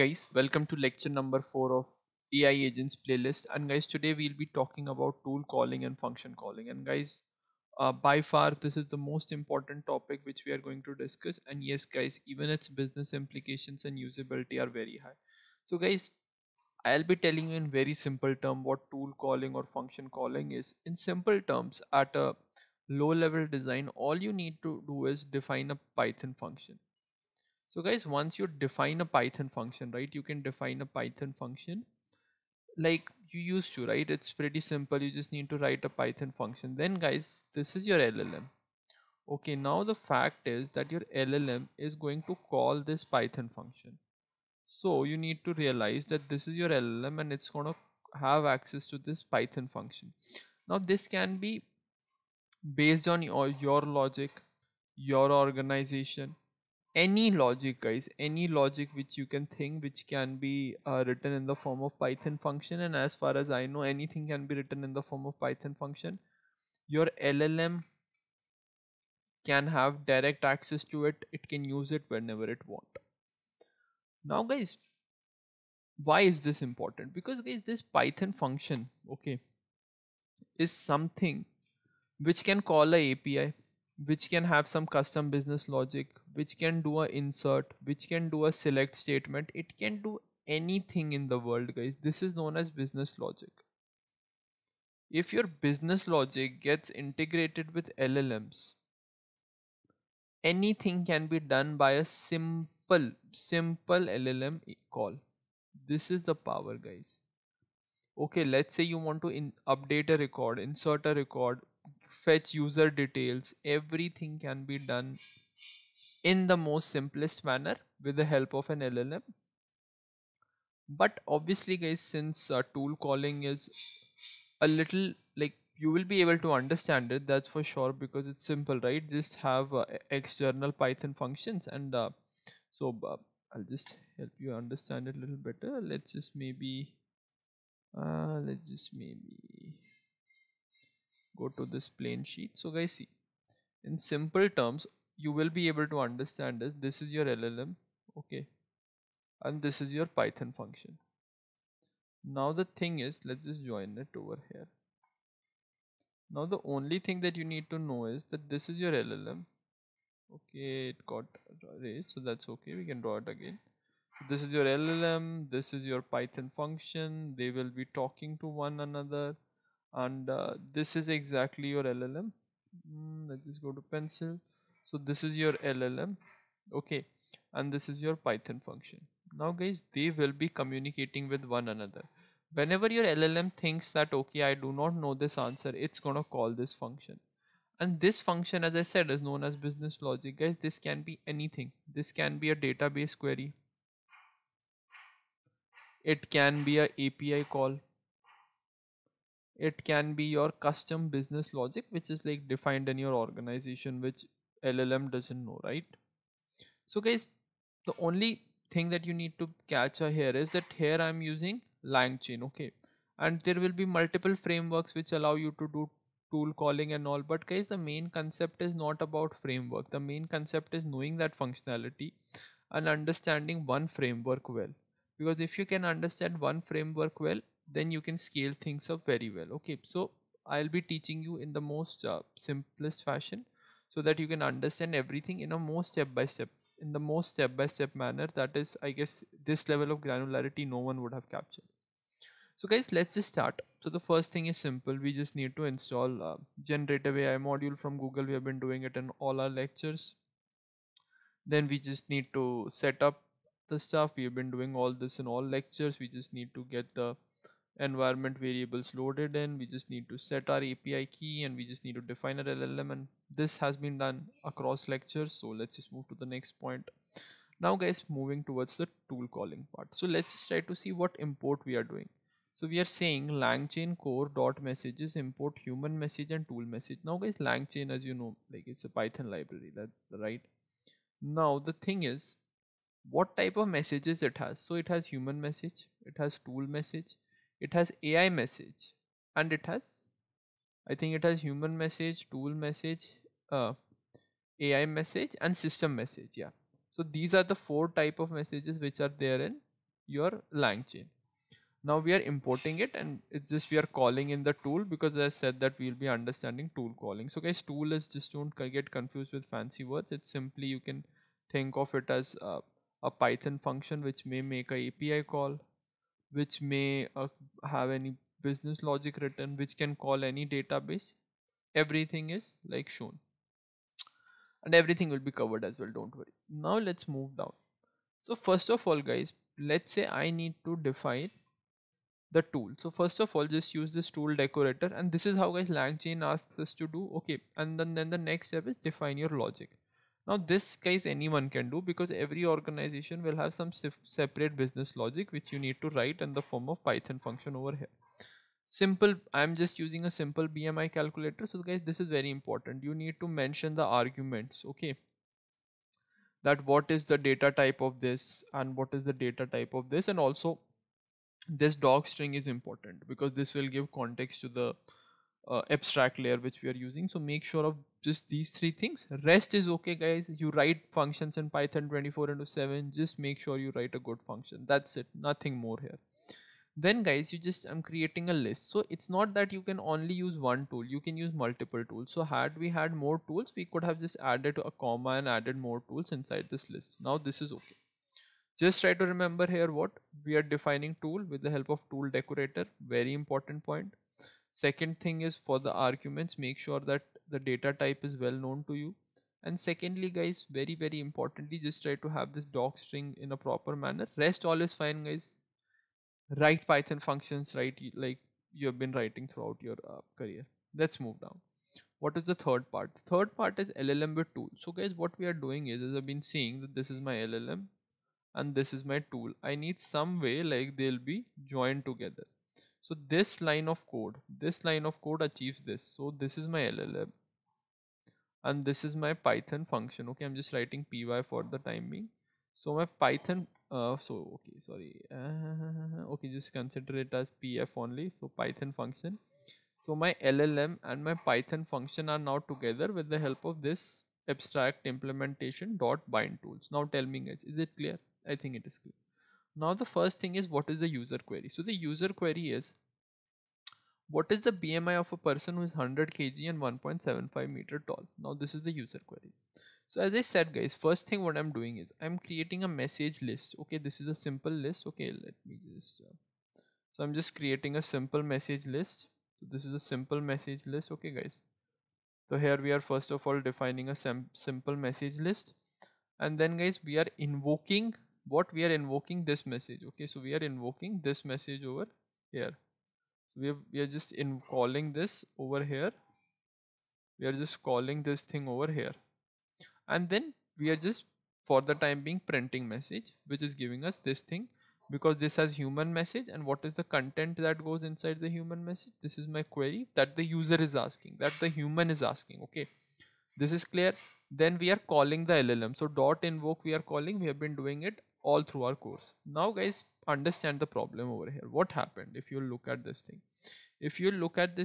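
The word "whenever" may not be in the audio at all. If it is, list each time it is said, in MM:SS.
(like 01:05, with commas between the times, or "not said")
01:12, 03:02.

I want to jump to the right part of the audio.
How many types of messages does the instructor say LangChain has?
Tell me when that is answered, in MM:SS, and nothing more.
04:57.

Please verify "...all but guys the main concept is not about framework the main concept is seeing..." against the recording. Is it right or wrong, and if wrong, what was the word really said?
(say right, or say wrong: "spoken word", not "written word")
wrong: "knowing", not "seeing".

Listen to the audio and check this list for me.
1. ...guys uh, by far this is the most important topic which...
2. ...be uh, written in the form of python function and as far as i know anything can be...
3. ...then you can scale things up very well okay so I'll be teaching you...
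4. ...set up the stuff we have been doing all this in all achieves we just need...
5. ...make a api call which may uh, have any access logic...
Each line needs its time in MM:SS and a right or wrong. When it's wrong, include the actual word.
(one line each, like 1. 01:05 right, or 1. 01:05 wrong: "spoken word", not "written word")
1. 00:06 right
2. 01:00 right
3. 03:47 right
4. 04:12 wrong: "lectures", not "achieves"
5. 05:14 wrong: "business", not "access".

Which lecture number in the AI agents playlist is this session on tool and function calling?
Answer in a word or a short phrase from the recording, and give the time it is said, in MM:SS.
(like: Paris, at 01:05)
4, at 00:00.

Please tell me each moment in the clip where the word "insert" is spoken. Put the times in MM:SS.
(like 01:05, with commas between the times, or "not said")
01:27, 01:50.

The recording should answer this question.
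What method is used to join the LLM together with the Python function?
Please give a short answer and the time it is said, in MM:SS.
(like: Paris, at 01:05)
bind tools, at 07:26.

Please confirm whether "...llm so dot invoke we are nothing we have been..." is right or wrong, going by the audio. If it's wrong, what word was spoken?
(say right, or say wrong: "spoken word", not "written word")
wrong: "calling", not "nothing".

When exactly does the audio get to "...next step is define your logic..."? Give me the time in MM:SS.
05:38.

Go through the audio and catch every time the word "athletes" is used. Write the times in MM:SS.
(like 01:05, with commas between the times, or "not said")
not said.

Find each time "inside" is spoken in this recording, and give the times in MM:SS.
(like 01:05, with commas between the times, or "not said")
06:26, 08:17.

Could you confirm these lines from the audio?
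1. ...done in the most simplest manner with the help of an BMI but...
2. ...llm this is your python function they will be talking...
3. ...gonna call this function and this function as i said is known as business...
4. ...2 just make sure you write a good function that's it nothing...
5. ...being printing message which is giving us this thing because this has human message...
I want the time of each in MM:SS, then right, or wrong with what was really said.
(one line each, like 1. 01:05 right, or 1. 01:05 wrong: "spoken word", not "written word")
1. 01:54 wrong: "LLM", not "BMI"
2. 02:44 right
3. 03:05 right
4. 06:12 wrong: "7", not "2"
5. 08:12 right.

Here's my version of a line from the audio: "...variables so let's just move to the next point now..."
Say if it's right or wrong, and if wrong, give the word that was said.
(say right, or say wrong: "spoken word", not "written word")
wrong: "lectures", not "variables".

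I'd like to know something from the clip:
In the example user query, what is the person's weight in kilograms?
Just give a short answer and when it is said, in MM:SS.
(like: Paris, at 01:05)
100, at 07:35.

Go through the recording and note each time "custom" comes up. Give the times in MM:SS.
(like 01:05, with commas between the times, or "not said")
01:24, 03:20.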